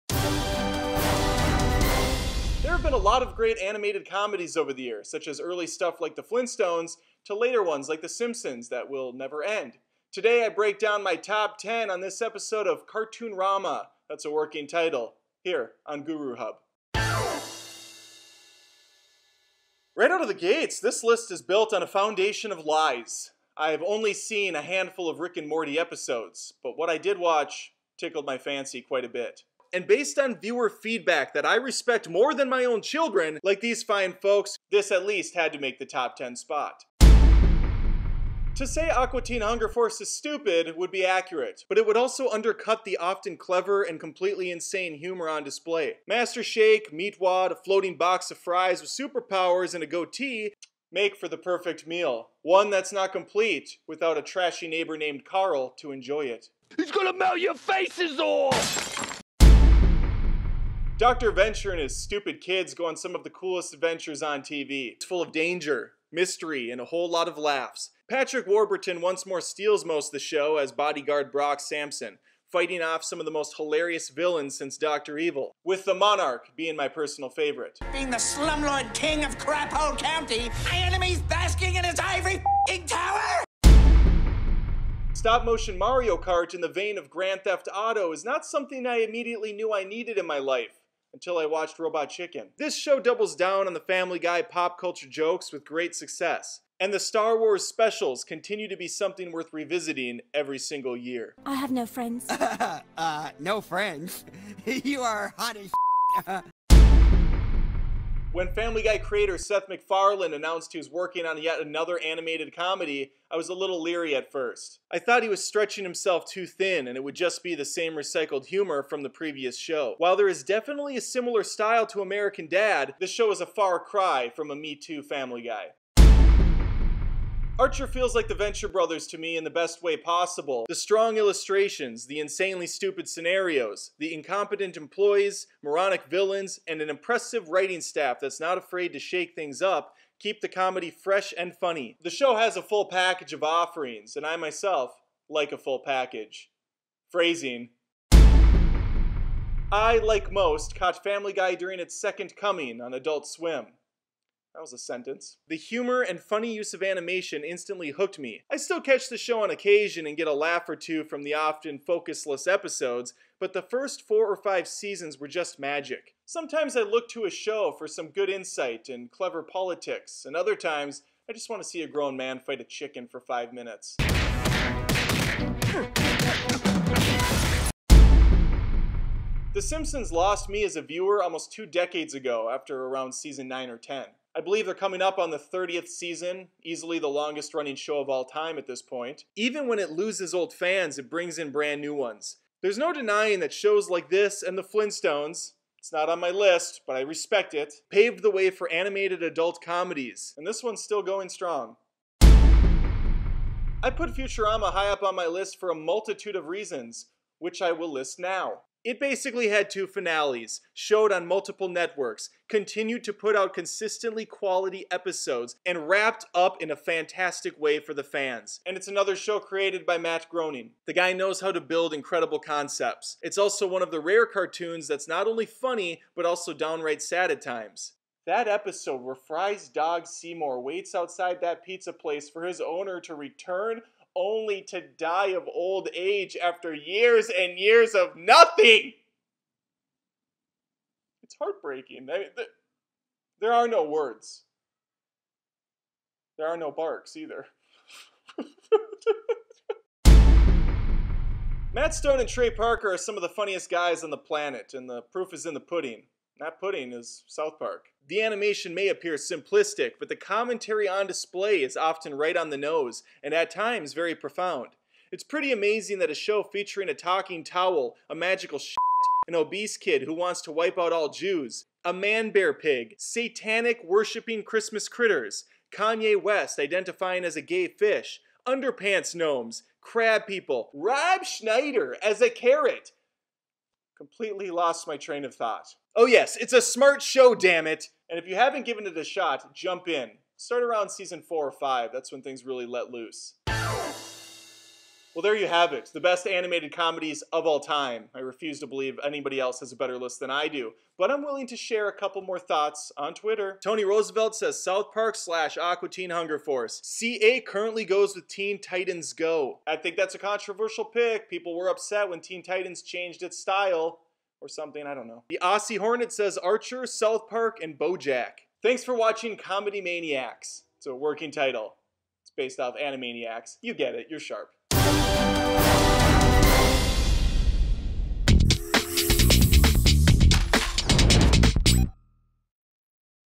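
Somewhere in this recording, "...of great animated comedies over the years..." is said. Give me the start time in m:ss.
0:03.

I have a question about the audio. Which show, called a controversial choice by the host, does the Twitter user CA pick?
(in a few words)
Teen Titans Go.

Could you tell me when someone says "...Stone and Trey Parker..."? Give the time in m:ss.
4:11.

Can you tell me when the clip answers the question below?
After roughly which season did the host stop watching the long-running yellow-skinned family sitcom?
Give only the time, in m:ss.
3:03.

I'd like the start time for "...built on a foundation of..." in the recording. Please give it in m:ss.
0:21.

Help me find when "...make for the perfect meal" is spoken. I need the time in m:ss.
0:50.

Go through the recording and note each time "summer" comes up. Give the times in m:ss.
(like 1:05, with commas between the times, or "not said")
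not said.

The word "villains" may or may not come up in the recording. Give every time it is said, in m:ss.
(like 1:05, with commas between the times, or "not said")
1:14, 2:16.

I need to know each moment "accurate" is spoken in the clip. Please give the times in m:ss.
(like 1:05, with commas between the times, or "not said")
0:41.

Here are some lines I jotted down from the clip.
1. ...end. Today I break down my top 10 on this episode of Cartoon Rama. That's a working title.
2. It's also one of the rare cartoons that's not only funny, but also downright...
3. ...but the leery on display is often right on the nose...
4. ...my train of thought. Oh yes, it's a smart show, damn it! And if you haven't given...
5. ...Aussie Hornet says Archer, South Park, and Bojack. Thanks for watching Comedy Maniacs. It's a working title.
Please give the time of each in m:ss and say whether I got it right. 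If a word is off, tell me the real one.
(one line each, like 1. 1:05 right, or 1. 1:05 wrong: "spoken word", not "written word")
1. 0:09 right
2. 3:43 right
3. 4:19 wrong: "commentary", not "leery"
4. 4:44 right
5. 5:15 right.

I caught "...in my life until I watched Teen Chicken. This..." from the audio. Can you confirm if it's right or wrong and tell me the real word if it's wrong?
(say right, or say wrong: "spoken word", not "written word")
wrong: "Robot", not "Teen".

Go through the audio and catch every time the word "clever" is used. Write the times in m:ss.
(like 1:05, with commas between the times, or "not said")
0:43, 2:49.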